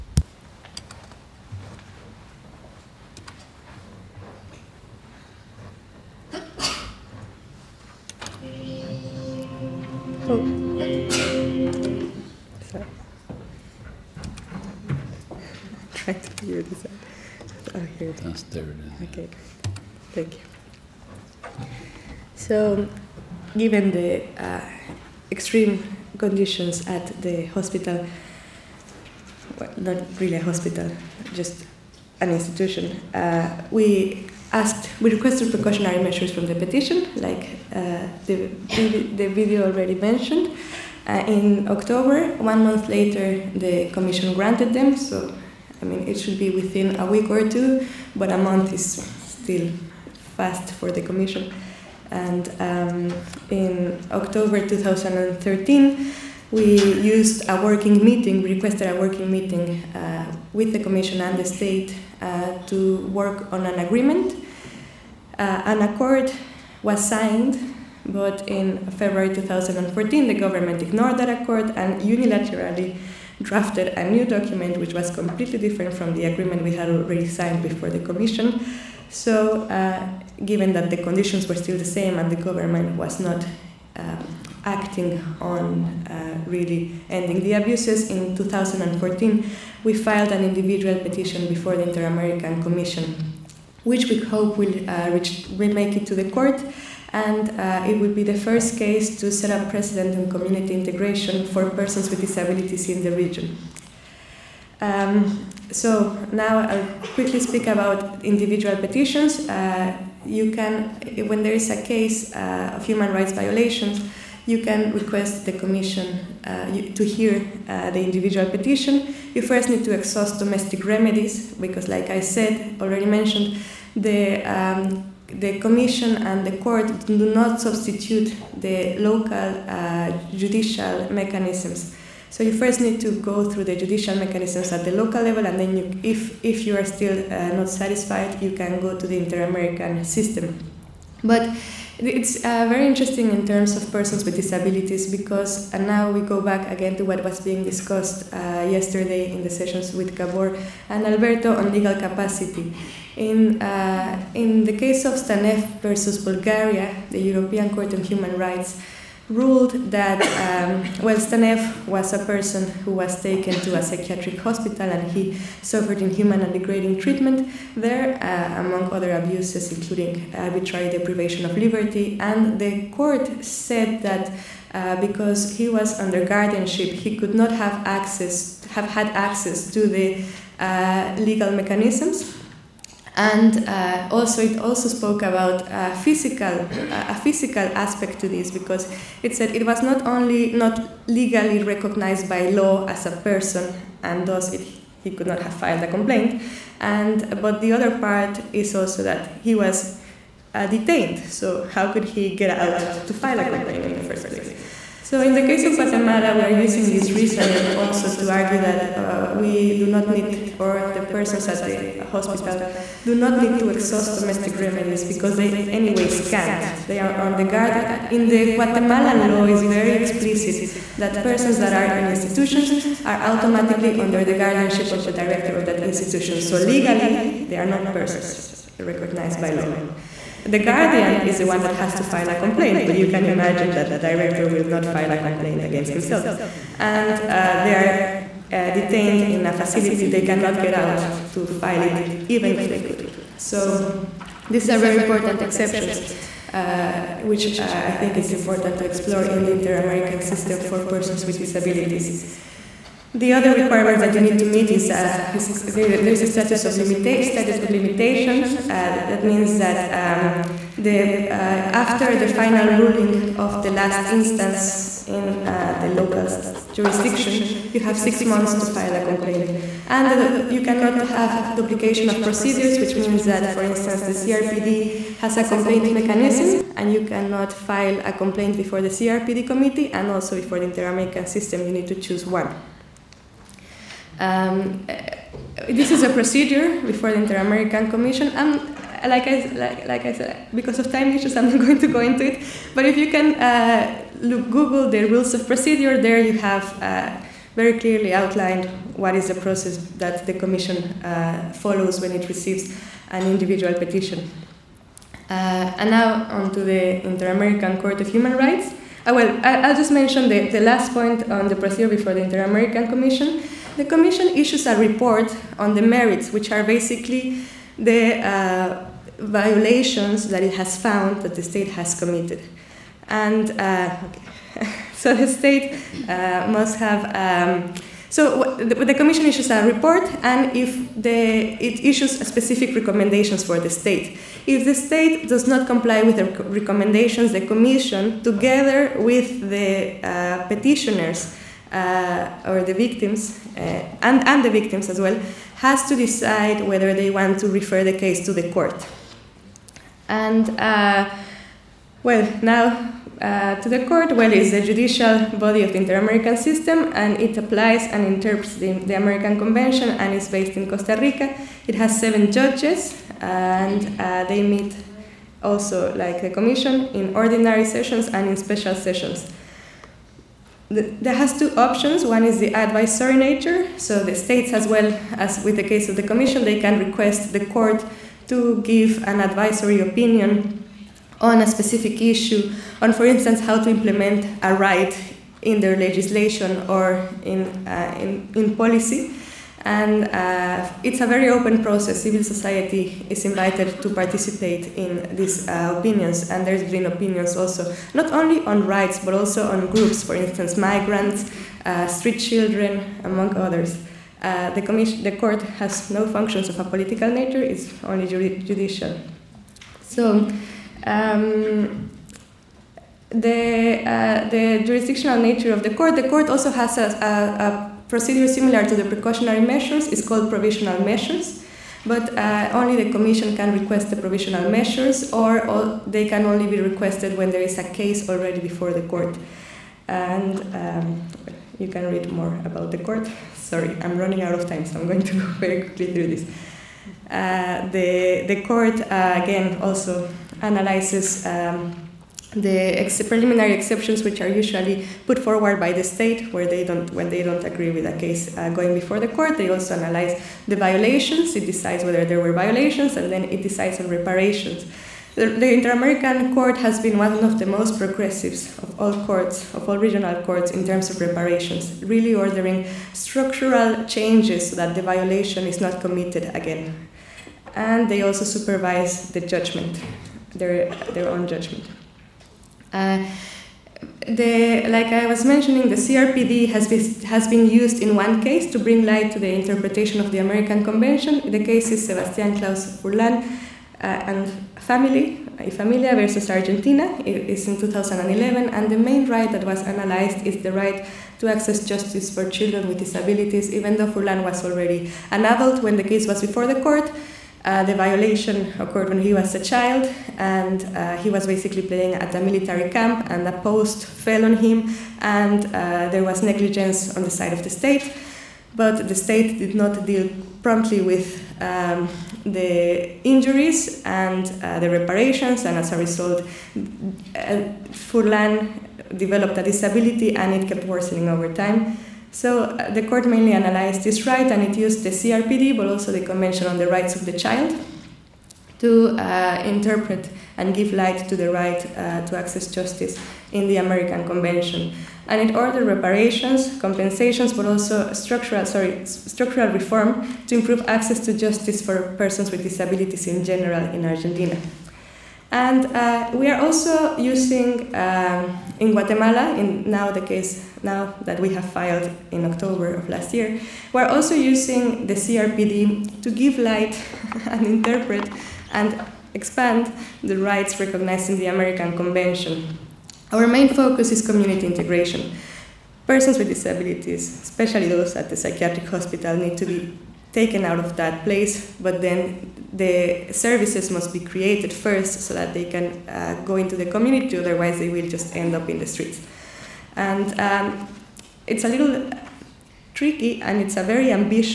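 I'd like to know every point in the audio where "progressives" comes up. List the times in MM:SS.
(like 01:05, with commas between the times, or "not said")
07:37.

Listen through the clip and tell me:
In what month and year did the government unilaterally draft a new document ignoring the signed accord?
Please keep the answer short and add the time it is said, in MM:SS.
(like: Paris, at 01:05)
February 2014, at 01:08.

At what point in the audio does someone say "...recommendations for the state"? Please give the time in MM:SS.
05:32.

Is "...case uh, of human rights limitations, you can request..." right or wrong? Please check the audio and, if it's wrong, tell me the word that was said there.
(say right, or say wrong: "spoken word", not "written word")
wrong: "violations", not "limitations".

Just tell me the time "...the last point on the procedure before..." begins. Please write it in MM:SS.
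05:10.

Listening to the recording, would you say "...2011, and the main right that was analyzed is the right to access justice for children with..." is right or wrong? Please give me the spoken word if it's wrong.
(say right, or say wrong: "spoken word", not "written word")
right.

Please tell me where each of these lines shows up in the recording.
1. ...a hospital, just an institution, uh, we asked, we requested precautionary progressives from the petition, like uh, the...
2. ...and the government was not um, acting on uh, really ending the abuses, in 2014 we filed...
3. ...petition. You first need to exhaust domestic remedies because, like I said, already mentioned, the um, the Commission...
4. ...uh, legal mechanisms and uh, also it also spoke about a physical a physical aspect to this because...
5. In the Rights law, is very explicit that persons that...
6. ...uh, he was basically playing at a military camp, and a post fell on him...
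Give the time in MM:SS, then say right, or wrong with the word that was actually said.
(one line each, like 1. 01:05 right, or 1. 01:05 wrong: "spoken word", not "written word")
1. 00:30 wrong: "measures", not "progressives"
2. 01:22 right
3. 01:58 right
4. 03:00 right
5. 03:38 wrong: "Guatemalan", not "Rights"
6. 08:20 right.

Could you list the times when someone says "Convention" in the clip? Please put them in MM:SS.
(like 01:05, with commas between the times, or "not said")
05:59, 08:00, 08:45, 08:54, 09:21.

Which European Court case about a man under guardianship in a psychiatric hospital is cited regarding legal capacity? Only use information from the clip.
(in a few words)
Stanev versus Bulgaria.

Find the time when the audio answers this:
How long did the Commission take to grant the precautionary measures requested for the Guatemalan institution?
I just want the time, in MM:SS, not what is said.
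00:42.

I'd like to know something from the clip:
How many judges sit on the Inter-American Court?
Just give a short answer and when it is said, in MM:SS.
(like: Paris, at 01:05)
7, at 06:01.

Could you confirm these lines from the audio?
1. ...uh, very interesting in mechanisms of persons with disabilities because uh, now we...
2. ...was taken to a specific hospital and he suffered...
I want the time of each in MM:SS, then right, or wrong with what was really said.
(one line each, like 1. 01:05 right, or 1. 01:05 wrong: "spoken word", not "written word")
1. 02:22 wrong: "terms", not "mechanisms"
2. 02:42 wrong: "psychiatric", not "specific".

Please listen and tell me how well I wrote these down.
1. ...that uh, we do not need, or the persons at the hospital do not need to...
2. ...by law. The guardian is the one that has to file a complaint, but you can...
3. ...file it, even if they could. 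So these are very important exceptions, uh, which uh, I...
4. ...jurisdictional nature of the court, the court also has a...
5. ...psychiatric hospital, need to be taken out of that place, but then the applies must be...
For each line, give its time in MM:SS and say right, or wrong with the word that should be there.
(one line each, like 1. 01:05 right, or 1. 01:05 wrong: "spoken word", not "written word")
1. 03:28 right
2. 03:49 right
3. 04:01 right
4. 06:54 right
5. 09:28 wrong: "services", not "applies".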